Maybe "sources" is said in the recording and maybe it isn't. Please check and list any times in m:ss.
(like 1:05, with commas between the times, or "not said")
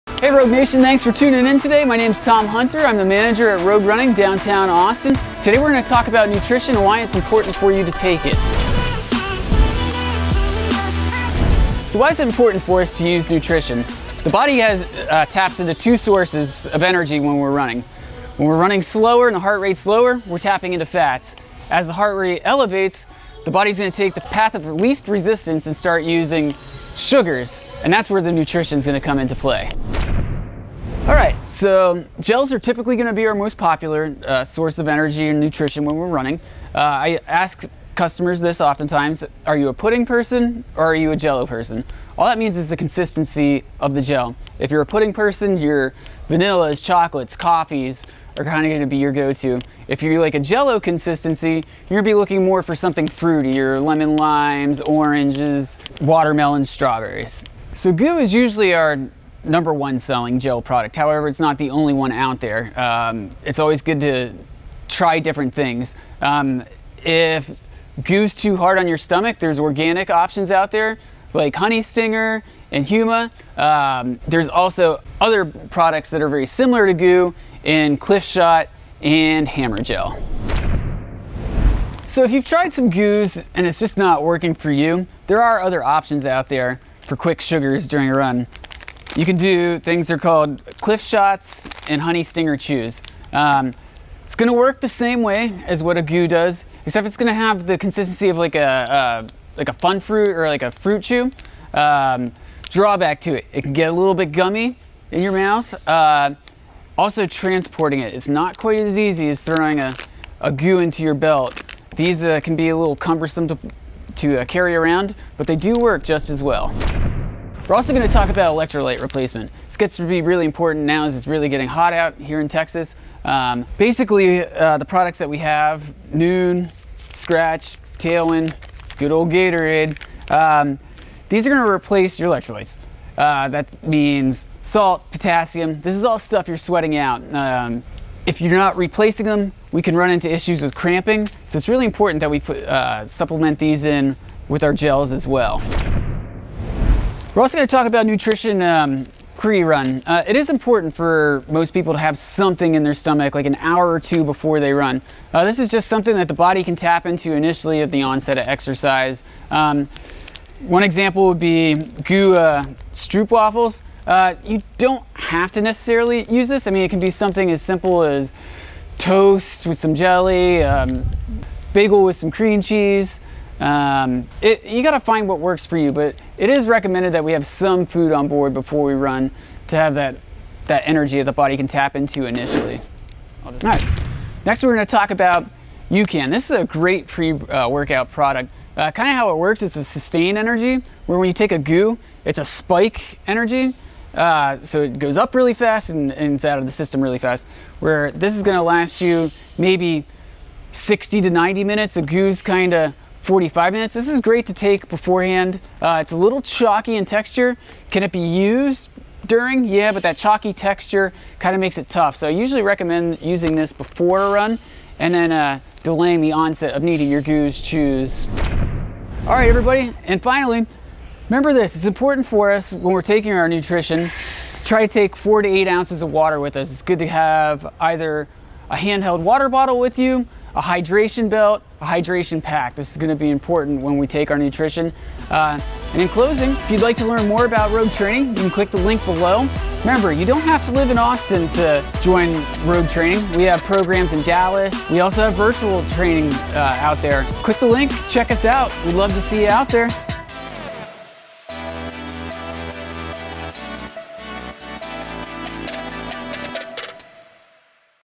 0:15, 0:34.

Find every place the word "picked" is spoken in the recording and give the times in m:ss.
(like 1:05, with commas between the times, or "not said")
not said.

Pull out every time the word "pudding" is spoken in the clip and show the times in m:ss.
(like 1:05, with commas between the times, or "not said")
0:39, 0:44.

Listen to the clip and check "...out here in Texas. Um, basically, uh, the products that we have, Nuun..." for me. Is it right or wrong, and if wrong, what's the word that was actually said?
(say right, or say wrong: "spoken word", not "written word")
right.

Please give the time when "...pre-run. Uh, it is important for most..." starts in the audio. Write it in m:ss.
2:29.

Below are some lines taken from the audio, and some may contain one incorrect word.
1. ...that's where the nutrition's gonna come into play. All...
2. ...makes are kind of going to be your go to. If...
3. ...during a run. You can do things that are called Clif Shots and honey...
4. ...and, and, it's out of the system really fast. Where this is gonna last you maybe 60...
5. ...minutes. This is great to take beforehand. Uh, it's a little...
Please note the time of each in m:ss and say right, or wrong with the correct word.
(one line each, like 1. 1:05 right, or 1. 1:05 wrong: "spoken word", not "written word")
1. 0:27 right
2. 0:47 wrong: "coffees", not "makes"
3. 1:27 right
4. 3:15 right
5. 3:23 right.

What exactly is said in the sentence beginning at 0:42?
All that means is the consistency of the gel.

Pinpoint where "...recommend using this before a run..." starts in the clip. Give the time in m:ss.
3:32.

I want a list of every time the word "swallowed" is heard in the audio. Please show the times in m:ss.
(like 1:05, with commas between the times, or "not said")
not said.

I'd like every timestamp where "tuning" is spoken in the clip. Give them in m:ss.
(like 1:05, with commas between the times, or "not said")
0:01.